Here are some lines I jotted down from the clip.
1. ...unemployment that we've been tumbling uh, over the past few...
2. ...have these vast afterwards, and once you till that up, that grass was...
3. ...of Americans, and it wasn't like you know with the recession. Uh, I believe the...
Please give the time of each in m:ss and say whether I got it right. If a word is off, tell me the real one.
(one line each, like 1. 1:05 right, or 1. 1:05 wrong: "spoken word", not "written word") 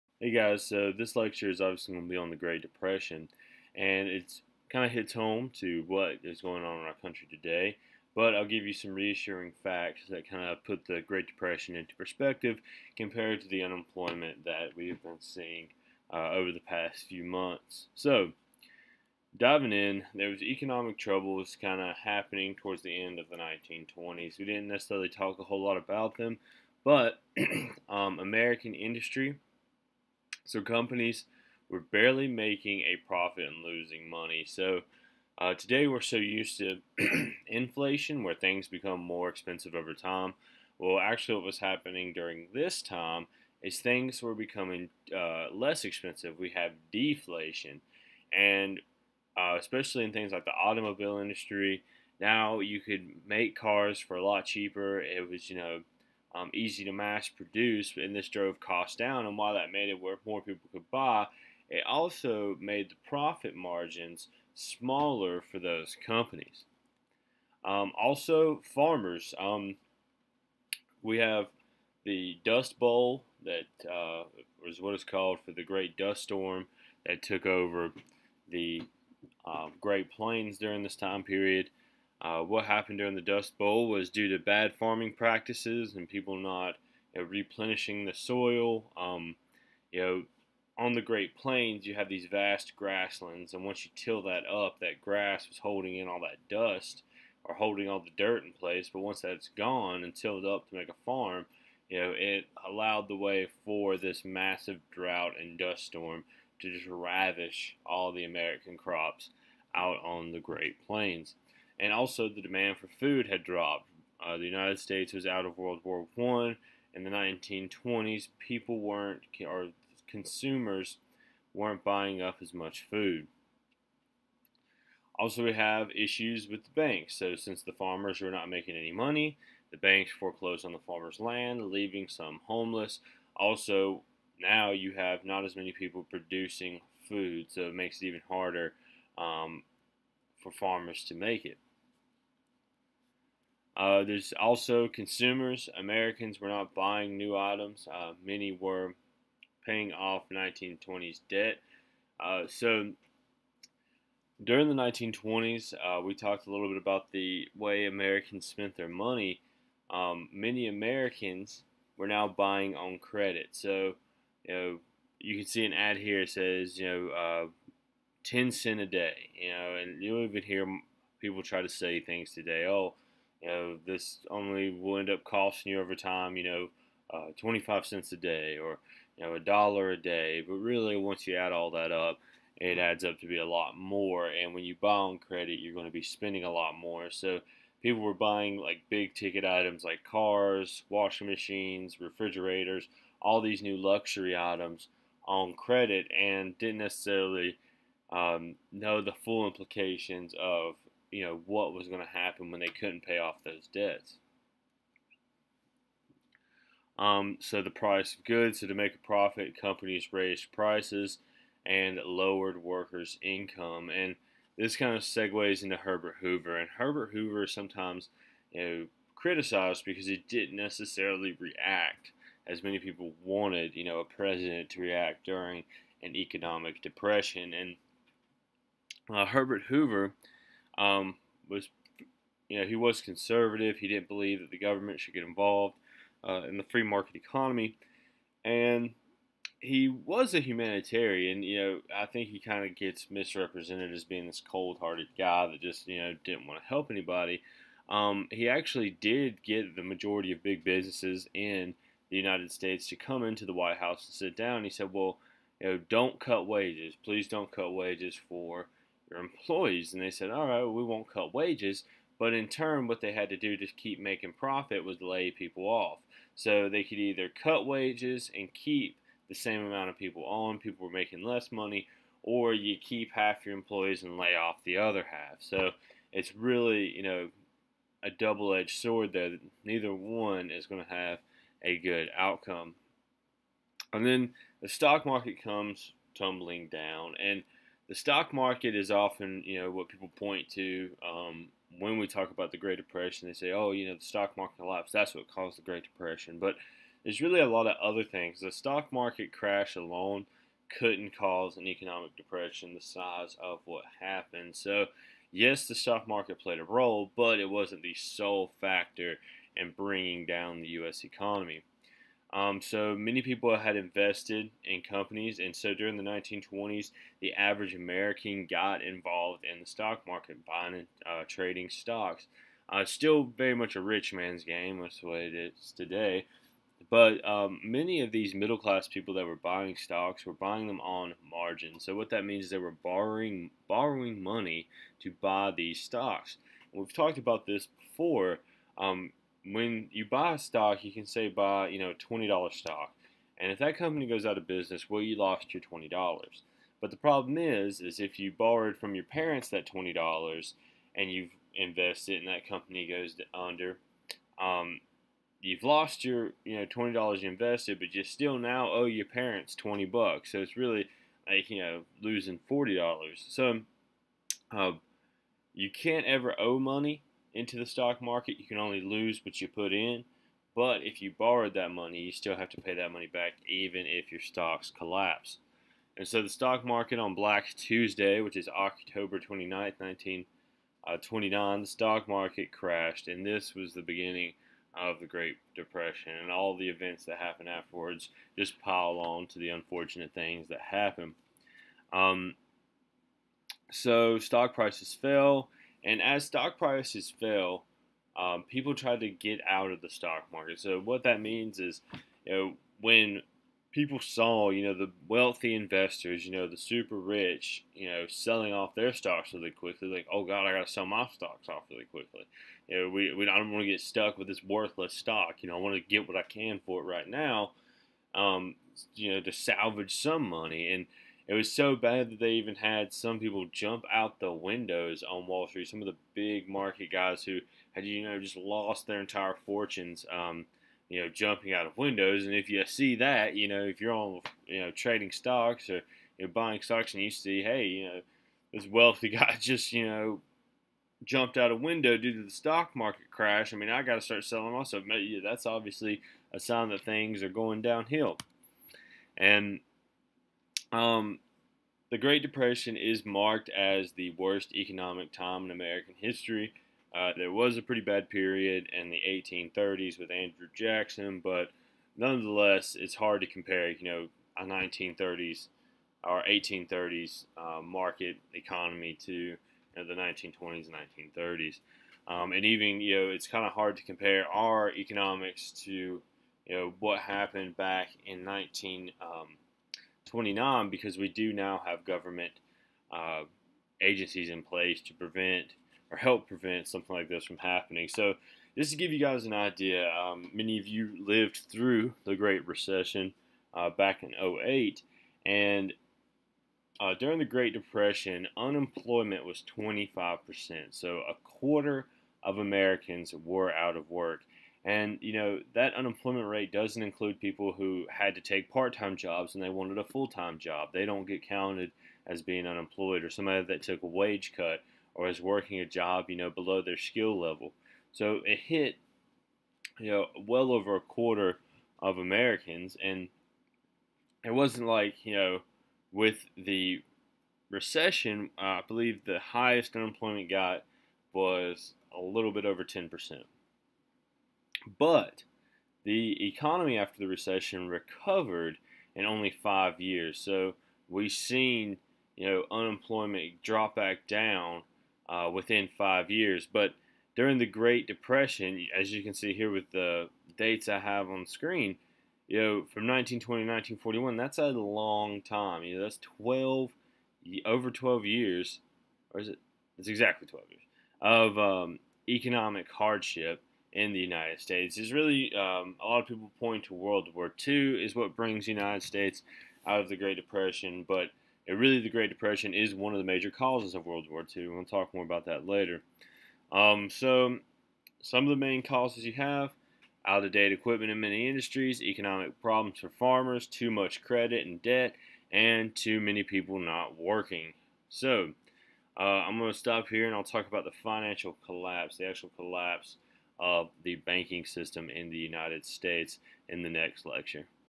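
1. 0:13 wrong: "seeing", not "tumbling"
2. 1:31 wrong: "grasslands", not "afterwards"
3. 8:41 right.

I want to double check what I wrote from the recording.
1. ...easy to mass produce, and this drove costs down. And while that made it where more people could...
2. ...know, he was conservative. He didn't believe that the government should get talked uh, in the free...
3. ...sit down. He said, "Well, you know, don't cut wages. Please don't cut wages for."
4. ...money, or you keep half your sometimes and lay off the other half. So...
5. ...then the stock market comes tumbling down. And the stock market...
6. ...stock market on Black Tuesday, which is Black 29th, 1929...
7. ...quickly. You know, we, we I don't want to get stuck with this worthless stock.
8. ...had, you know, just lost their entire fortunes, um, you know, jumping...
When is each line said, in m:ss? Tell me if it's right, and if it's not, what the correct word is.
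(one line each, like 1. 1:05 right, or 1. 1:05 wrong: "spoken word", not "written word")
1. 0:56 right
2. 3:52 wrong: "involved", not "talked"
3. 4:14 right
4. 4:31 wrong: "employees", not "sometimes"
5. 4:44 right
6. 6:16 wrong: "October", not "Black"
7. 6:51 right
8. 7:07 right.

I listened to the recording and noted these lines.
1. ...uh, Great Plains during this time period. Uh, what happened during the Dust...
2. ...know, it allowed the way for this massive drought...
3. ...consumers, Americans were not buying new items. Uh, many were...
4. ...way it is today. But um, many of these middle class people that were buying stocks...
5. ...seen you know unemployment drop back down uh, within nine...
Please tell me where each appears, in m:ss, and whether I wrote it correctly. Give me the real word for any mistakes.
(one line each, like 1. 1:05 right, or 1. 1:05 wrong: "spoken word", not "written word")
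1. 1:19 right
2. 1:41 right
3. 2:24 right
4. 5:25 right
5. 9:01 wrong: "five", not "nine".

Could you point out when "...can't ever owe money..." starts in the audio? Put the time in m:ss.
6:05.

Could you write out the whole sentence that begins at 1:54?
Uh, the United States was out of World War One in the 1920s.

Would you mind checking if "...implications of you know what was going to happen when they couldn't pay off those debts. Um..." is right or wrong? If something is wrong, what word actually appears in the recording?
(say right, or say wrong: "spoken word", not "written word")
right.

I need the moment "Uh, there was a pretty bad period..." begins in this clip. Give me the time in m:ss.
7:36.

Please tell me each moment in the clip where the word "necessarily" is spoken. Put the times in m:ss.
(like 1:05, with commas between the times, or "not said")
0:24, 3:16, 3:40.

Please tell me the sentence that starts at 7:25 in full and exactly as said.
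That's obviously a sign that things are going downhill.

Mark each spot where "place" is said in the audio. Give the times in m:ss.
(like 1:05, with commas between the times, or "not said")
1:38, 8:04.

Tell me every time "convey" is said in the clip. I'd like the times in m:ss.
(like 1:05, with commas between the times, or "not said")
not said.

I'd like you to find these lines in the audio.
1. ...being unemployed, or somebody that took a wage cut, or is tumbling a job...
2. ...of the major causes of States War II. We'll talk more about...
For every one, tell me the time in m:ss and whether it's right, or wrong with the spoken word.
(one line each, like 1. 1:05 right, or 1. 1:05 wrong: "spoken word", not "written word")
1. 8:32 wrong: "working", not "tumbling"
2. 9:32 wrong: "World", not "States".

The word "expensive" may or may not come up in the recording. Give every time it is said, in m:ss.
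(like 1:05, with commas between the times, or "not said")
0:39, 0:45.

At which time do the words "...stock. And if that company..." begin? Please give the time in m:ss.
5:42.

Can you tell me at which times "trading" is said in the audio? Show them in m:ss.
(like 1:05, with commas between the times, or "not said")
5:21, 7:14.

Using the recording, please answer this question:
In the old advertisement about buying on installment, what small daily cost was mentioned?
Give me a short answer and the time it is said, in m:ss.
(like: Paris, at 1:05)
10 cents a day, at 2:48.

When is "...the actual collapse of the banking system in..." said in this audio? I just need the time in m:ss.
9:51.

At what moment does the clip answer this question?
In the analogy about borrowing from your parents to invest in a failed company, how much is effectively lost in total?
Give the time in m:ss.
6:02.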